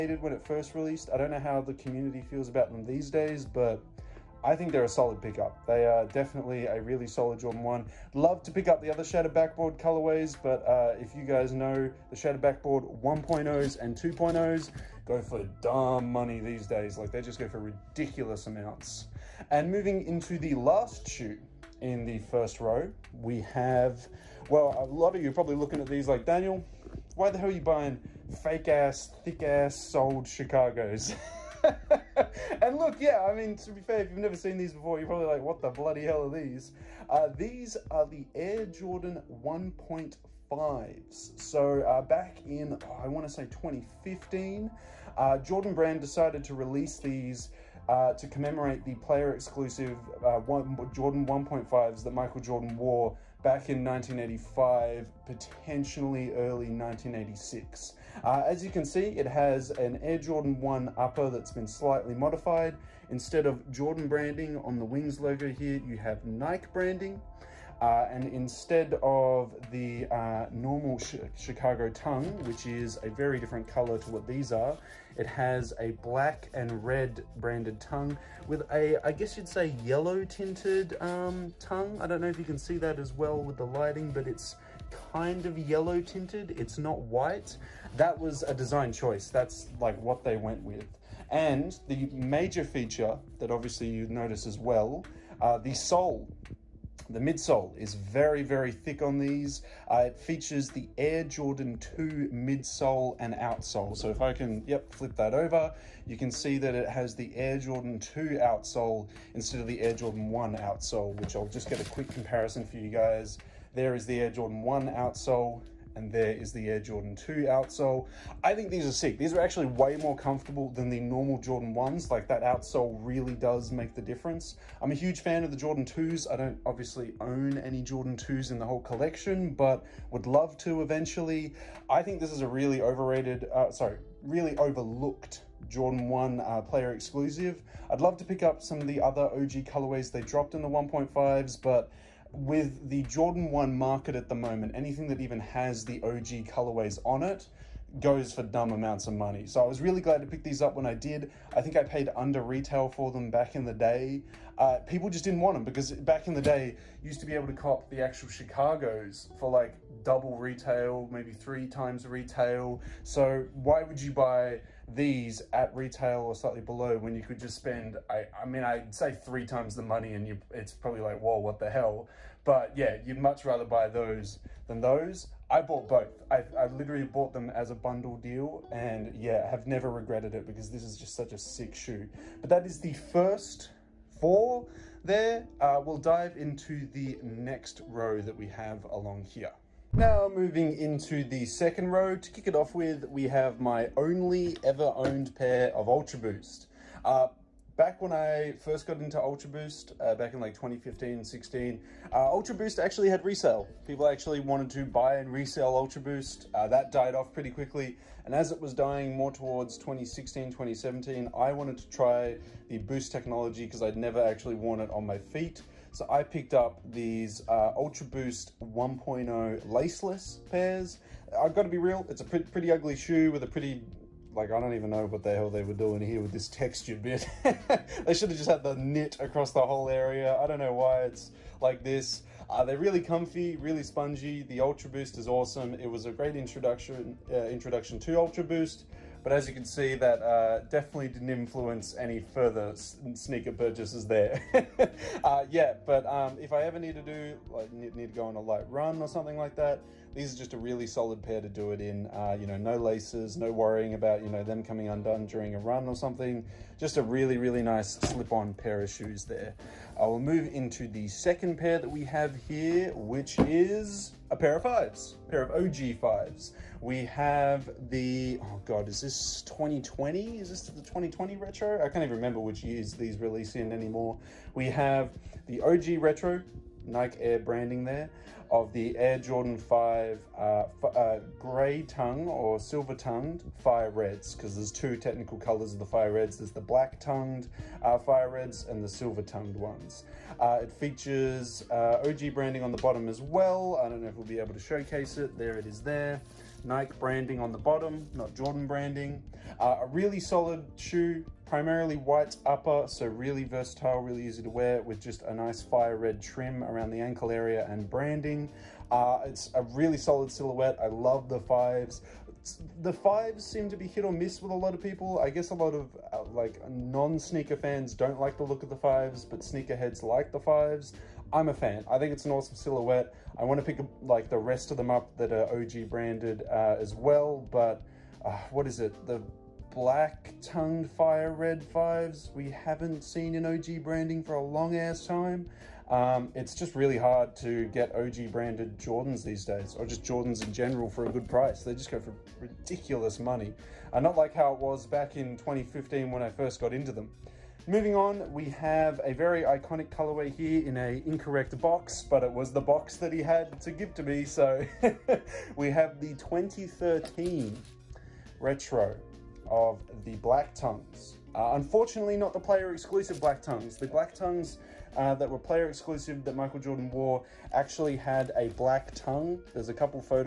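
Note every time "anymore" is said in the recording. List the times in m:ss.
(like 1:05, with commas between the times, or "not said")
4:33.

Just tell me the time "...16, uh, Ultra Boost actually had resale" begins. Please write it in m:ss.
3:21.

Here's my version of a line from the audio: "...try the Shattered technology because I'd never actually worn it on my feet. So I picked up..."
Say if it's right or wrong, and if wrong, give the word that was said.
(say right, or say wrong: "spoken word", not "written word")
wrong: "Boost", not "Shattered".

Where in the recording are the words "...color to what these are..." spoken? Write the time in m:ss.
1:13.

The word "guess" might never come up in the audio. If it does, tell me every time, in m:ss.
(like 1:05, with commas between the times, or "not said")
1:19, 5:15.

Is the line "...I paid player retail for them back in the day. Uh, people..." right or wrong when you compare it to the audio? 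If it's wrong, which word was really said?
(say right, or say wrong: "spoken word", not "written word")
wrong: "under", not "player".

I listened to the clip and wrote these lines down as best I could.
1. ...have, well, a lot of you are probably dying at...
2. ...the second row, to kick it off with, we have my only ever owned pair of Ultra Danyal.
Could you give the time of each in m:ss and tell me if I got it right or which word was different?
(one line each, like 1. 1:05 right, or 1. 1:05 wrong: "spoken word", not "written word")
1. 0:23 wrong: "looking", not "dying"
2. 3:11 wrong: "Boost", not "Danyal".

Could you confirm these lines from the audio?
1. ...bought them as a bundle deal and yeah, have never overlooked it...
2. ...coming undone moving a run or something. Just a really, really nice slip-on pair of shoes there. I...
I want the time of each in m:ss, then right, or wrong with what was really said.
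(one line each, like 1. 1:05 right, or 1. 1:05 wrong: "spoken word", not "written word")
1. 2:57 wrong: "regretted", not "overlooked"
2. 4:14 wrong: "during", not "moving".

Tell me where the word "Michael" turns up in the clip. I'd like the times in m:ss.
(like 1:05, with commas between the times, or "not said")
0:52, 6:06.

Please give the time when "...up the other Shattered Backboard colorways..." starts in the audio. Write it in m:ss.
0:08.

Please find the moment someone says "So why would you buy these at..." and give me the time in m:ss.
2:43.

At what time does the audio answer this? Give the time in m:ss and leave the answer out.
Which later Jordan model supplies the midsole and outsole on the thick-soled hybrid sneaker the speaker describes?
1:40.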